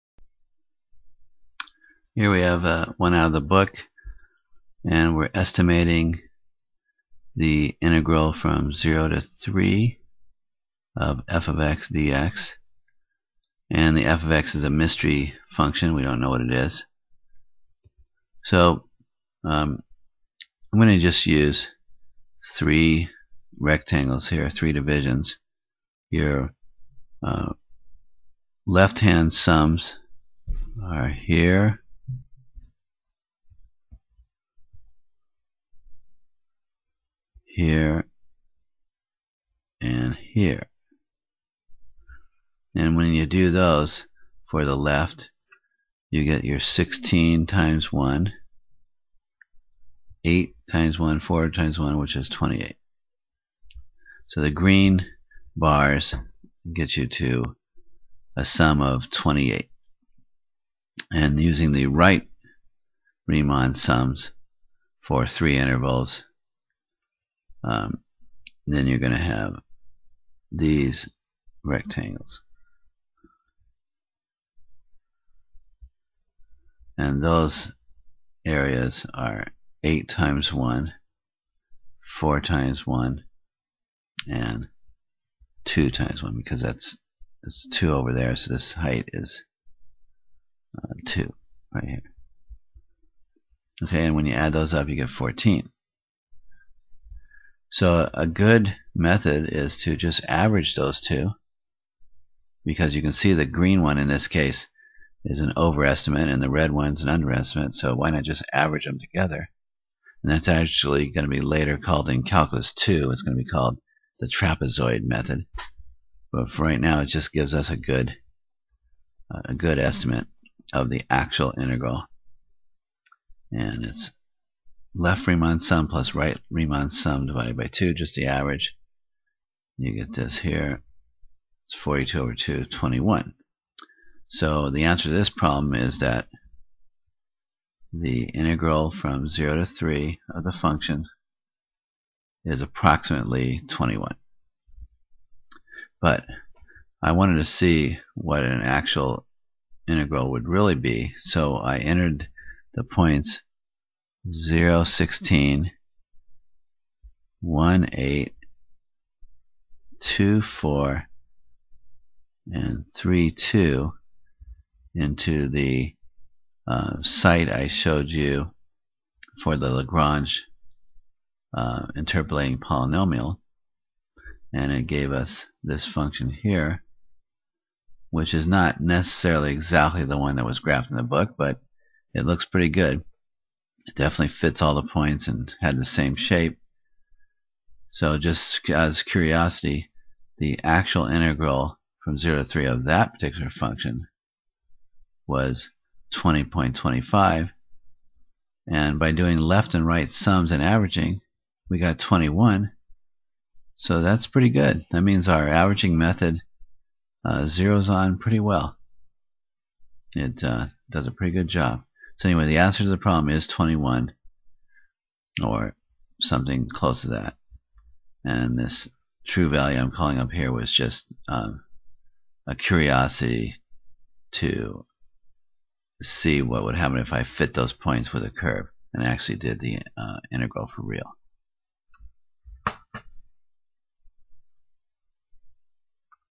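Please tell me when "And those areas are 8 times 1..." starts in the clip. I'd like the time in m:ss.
1:16.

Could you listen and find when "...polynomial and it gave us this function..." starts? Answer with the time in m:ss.
2:52.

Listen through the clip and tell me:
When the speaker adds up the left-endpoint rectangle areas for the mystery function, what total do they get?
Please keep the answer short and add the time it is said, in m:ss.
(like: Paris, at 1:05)
28, at 0:51.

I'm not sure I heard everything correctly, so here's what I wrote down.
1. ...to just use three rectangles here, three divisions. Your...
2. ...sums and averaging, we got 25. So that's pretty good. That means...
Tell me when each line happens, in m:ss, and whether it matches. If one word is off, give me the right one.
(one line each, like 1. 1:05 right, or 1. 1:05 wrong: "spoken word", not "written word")
1. 0:20 right
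2. 3:20 wrong: "21", not "25".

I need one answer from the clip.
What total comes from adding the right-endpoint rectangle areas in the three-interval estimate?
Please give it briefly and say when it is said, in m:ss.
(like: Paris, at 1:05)
14, at 1:34.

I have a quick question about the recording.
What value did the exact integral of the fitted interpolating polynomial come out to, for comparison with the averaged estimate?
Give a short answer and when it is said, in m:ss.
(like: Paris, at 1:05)
20.25, at 3:16.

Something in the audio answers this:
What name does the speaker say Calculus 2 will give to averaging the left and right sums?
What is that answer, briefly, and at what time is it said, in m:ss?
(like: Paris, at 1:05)
trapezoid method, at 1:54.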